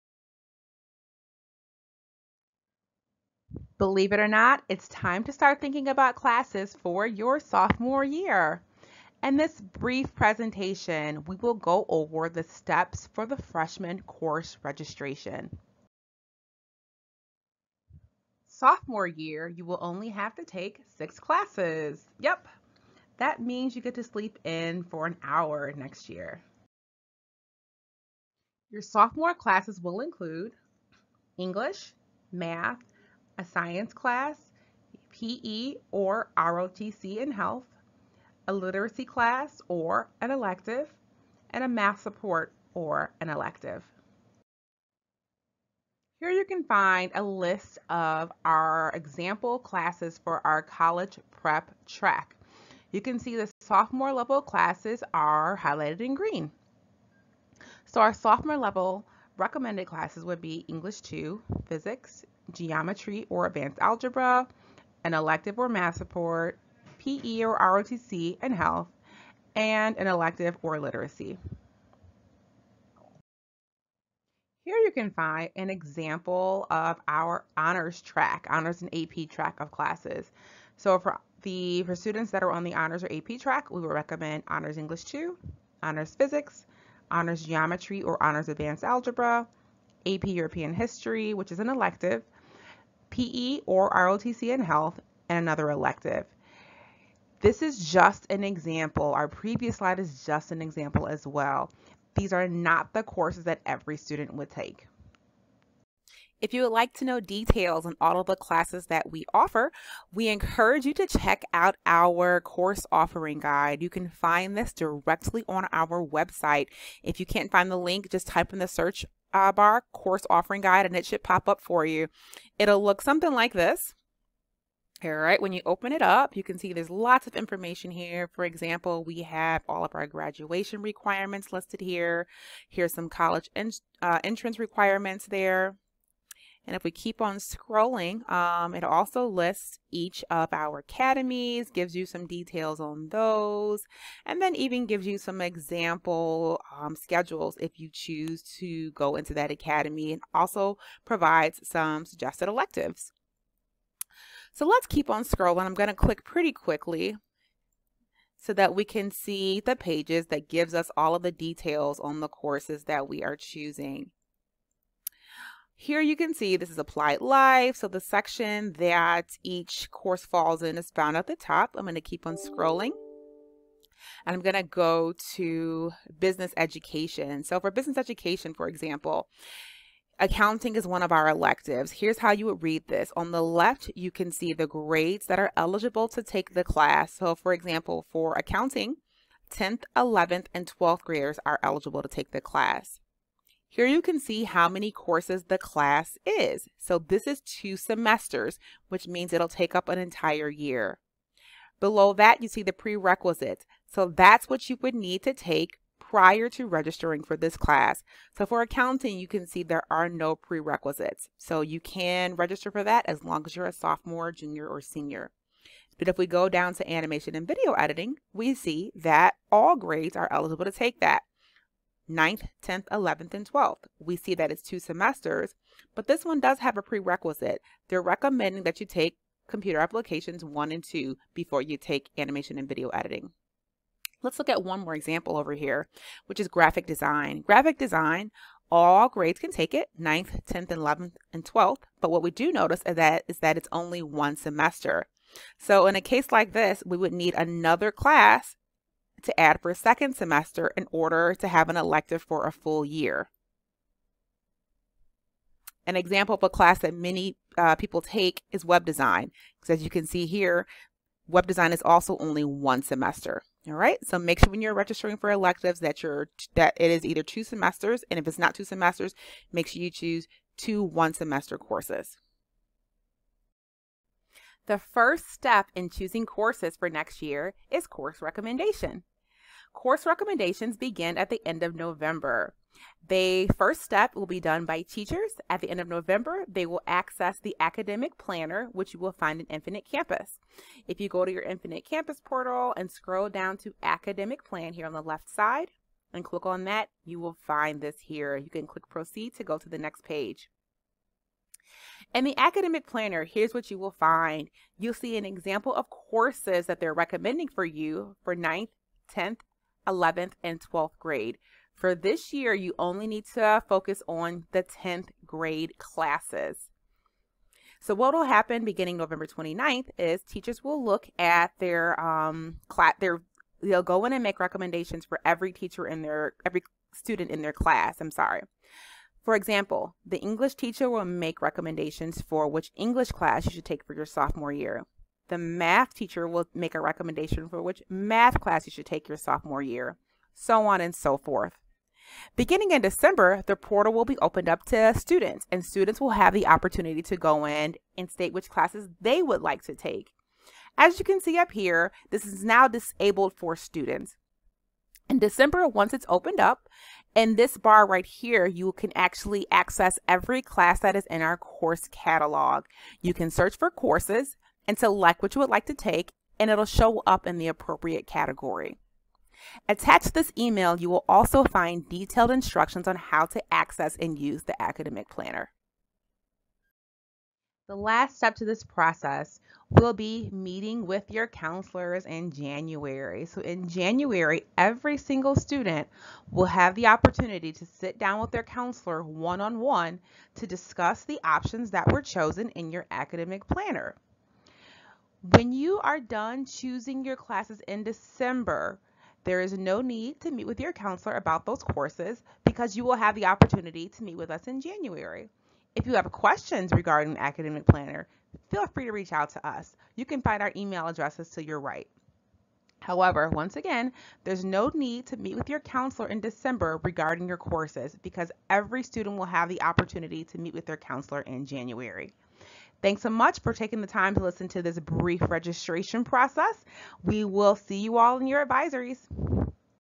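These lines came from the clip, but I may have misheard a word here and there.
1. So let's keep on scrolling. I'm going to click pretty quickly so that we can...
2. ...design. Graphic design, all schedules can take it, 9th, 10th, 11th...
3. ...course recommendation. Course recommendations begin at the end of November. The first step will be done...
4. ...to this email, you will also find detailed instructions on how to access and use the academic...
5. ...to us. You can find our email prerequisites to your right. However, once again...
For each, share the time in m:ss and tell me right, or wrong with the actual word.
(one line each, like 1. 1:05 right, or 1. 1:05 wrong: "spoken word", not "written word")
1. 2:34 right
2. 3:56 wrong: "grades", not "schedules"
3. 4:37 right
4. 6:10 right
5. 6:49 wrong: "addresses", not "prerequisites".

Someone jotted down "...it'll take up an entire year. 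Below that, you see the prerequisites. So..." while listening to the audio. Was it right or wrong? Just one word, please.
right.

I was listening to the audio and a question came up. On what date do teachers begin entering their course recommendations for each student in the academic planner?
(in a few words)
November 29.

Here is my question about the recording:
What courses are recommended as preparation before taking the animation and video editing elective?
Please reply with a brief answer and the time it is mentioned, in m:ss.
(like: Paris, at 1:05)
Computer applications 1 and 2, at 3:49.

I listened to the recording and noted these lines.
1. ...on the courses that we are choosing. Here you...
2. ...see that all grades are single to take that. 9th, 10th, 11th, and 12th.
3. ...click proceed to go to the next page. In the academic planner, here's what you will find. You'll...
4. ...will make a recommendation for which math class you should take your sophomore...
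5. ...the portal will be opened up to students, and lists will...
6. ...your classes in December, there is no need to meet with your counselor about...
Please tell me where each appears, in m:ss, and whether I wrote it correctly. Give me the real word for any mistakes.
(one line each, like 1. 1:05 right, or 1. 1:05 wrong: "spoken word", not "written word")
1. 2:41 right
2. 3:38 wrong: "eligible", not "single"
3. 4:58 right
4. 5:36 right
5. 5:43 wrong: "students", not "lists"
6. 6:37 right.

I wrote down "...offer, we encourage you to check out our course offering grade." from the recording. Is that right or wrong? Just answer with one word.
wrong.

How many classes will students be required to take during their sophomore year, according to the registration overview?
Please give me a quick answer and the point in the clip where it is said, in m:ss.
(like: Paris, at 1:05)
6, at 0:20.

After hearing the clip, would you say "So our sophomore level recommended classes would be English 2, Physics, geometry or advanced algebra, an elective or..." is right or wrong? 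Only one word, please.
right.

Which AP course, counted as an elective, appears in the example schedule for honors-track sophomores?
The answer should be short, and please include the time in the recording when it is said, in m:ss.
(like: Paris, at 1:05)
AP European history, at 1:30.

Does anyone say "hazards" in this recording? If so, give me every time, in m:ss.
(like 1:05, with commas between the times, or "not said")
not said.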